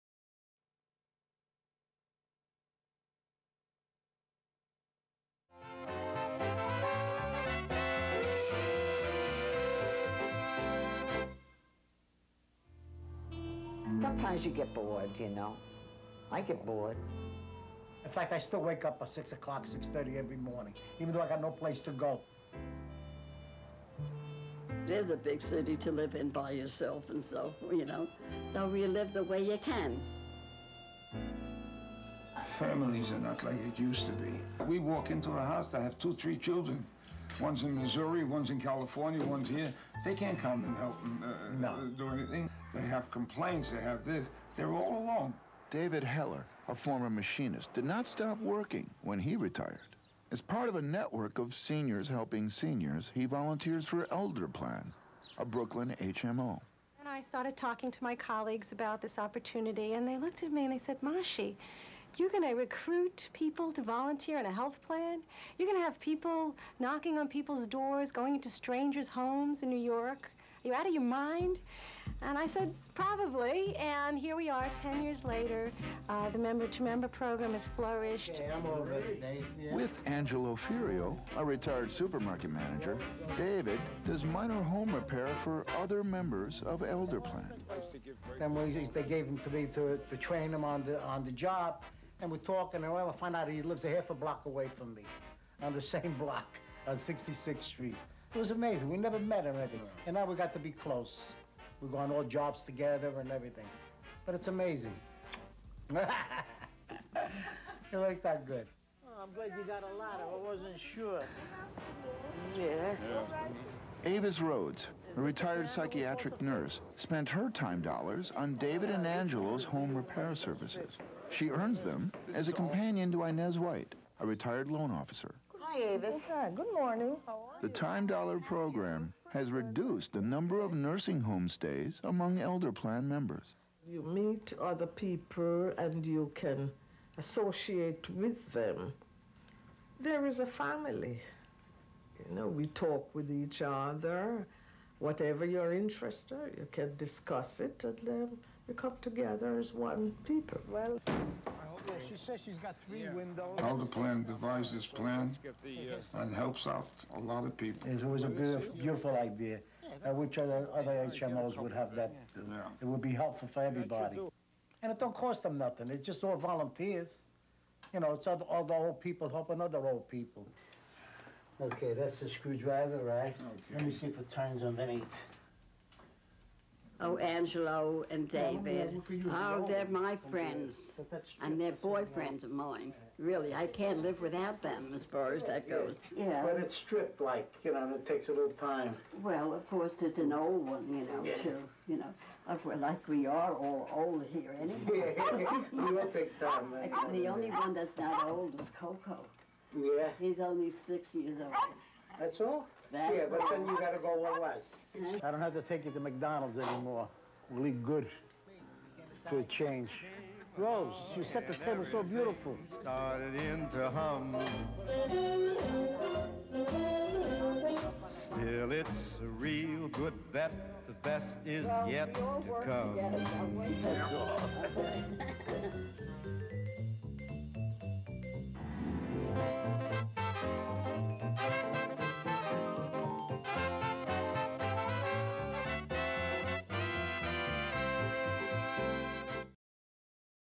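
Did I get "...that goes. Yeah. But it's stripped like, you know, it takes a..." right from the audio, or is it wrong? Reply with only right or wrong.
right.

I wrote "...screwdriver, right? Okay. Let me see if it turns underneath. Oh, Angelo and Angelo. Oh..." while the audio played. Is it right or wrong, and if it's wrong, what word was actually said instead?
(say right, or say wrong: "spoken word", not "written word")
wrong: "David", not "Angelo".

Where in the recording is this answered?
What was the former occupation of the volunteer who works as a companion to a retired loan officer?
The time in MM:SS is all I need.
01:55.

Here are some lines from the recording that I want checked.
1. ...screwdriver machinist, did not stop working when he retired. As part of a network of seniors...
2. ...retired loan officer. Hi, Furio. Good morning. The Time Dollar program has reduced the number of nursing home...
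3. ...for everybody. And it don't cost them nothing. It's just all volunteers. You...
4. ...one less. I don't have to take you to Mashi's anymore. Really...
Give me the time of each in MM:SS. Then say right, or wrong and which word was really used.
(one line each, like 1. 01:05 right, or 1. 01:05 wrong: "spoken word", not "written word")
1. 00:46 wrong: "former", not "screwdriver"
2. 02:04 wrong: "Avis", not "Furio"
3. 02:43 right
4. 03:24 wrong: "McDonald", not "Mashi".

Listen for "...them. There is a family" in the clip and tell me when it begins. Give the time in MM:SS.
02:18.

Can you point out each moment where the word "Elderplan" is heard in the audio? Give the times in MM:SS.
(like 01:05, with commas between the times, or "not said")
00:54, 01:26, 02:12.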